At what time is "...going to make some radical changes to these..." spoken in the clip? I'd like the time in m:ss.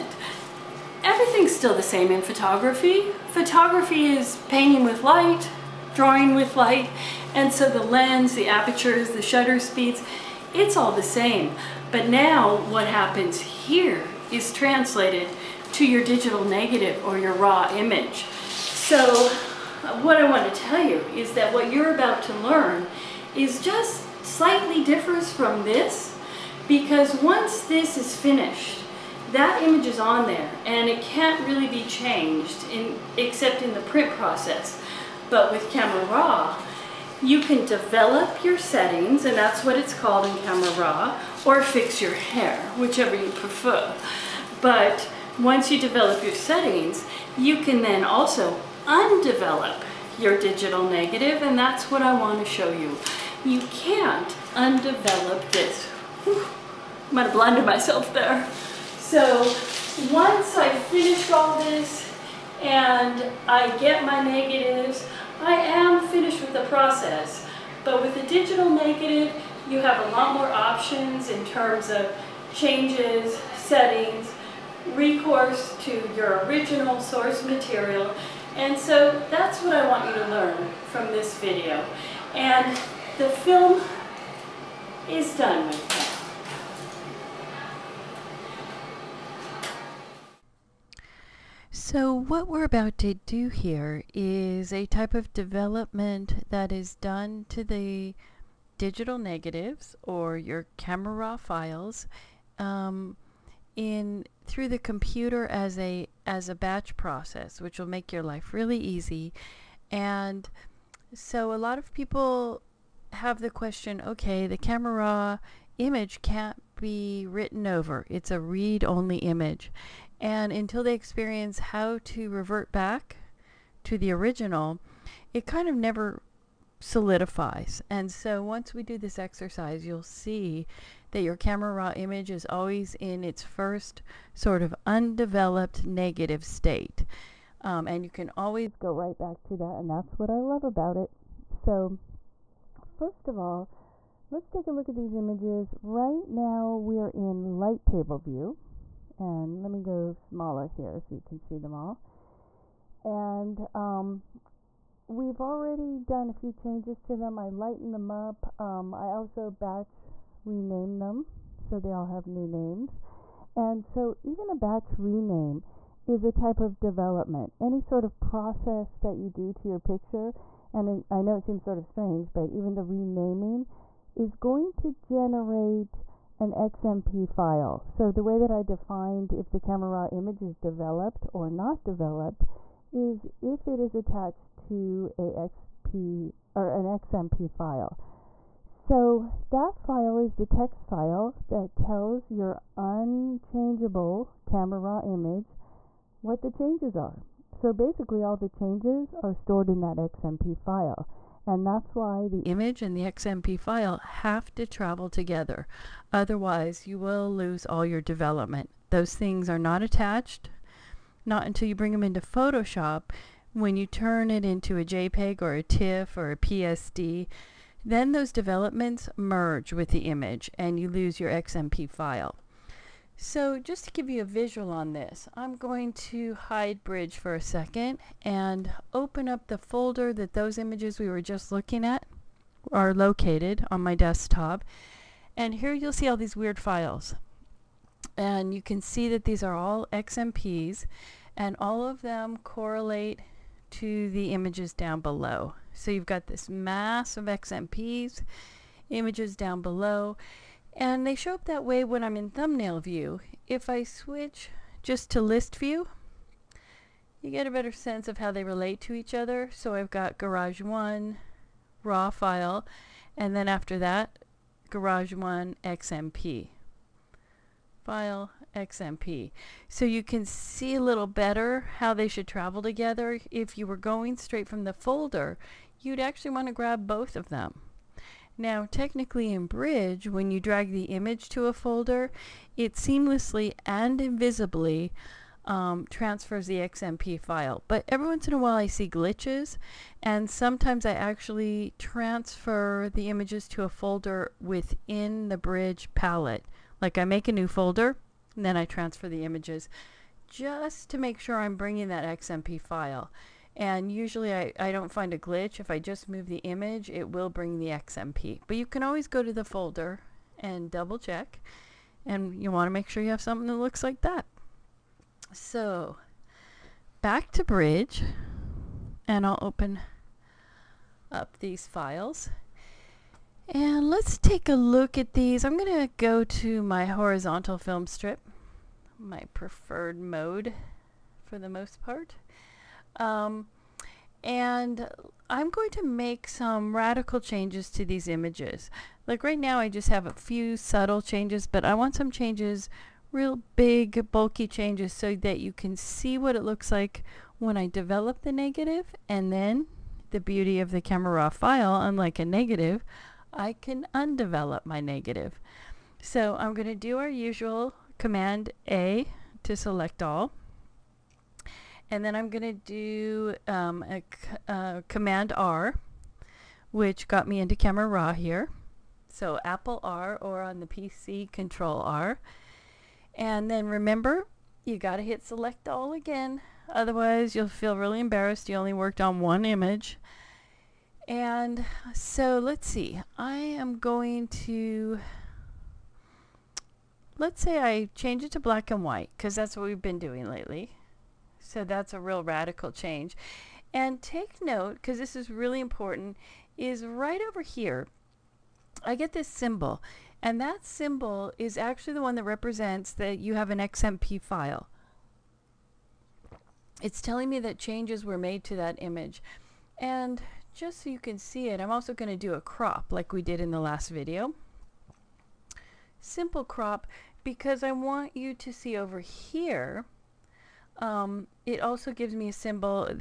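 5:35.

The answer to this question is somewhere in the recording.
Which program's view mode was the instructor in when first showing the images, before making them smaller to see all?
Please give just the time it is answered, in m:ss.
2:27.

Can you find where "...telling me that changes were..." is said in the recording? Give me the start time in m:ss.
6:47.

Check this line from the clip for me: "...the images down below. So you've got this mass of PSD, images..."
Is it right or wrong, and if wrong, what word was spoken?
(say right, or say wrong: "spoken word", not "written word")
wrong: "XMPs", not "PSD".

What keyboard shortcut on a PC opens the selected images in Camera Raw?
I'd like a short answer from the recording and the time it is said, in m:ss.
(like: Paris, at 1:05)
Control R, at 6:11.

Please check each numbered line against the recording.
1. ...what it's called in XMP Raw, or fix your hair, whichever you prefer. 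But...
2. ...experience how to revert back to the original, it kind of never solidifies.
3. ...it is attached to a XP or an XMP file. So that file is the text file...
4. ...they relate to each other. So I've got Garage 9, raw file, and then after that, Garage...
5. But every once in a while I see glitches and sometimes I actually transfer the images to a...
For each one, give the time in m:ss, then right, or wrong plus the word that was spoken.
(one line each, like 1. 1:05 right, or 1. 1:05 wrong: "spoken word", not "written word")
1. 0:39 wrong: "Camera", not "XMP"
2. 2:00 right
3. 3:03 right
4. 4:18 wrong: "1", not "9"
5. 4:47 right.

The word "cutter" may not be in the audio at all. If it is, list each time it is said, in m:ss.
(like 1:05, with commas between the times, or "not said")
not said.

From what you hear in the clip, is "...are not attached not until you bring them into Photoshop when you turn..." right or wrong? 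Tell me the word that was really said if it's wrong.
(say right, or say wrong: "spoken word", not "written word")
right.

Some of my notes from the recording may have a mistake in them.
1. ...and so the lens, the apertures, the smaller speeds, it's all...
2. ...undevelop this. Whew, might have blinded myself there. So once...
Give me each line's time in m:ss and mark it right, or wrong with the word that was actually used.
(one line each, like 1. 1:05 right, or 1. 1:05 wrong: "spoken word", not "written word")
1. 0:07 wrong: "shutter", not "smaller"
2. 0:54 right.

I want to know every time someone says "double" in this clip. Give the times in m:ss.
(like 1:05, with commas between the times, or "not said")
5:10.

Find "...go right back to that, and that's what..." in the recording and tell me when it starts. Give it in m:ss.
2:18.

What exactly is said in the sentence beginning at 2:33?
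And um, we've already done a few changes to them.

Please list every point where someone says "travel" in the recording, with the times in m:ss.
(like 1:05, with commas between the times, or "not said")
3:24, 4:32.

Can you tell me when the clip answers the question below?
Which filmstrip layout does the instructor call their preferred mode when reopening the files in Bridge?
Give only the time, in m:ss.
5:26.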